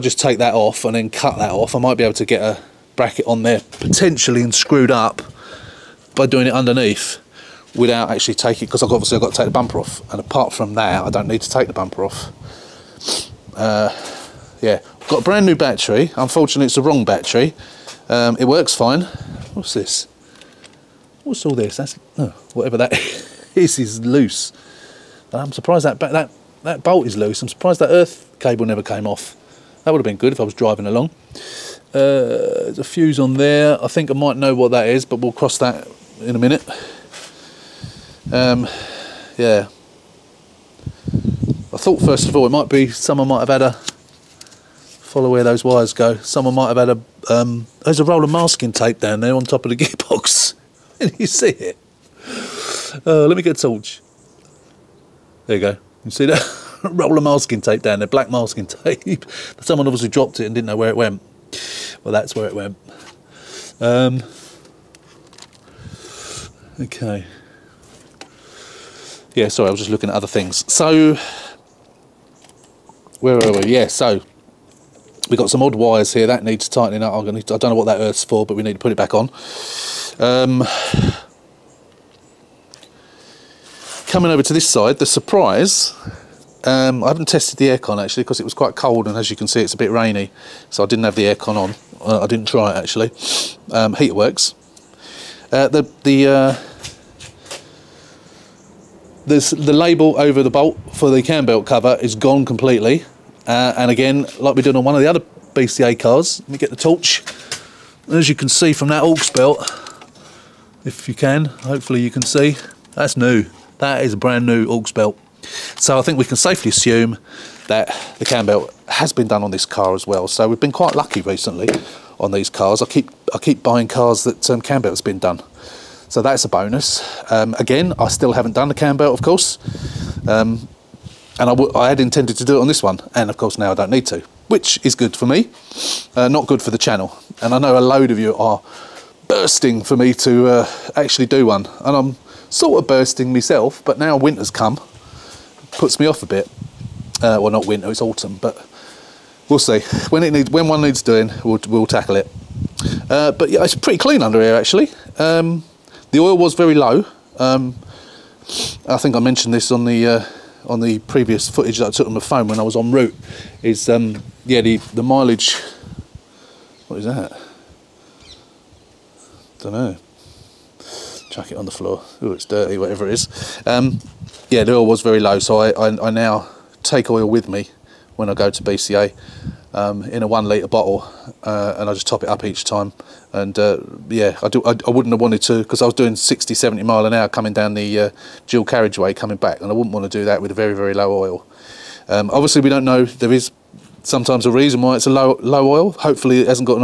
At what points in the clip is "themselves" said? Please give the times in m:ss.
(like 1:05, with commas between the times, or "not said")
not said.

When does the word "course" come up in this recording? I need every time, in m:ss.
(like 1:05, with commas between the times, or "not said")
2:09, 2:13.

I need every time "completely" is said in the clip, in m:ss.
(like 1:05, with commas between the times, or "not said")
1:42.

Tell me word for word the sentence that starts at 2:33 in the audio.
Uh, but yeah, it's pretty clean under here actually.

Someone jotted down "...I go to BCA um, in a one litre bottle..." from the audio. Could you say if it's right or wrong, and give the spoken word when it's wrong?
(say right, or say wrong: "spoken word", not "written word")
right.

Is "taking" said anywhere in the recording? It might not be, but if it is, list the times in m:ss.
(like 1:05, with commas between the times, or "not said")
0:08.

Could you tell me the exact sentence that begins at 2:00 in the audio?
So we've been quite lucky recently on these cars.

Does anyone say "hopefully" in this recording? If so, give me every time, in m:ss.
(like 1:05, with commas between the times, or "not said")
1:51, 3:15.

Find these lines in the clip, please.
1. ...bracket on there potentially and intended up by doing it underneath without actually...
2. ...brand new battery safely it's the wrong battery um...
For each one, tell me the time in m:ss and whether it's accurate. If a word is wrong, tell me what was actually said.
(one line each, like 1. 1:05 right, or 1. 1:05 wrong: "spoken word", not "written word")
1. 0:02 wrong: "screwed", not "intended"
2. 0:15 wrong: "unfortunately", not "safely".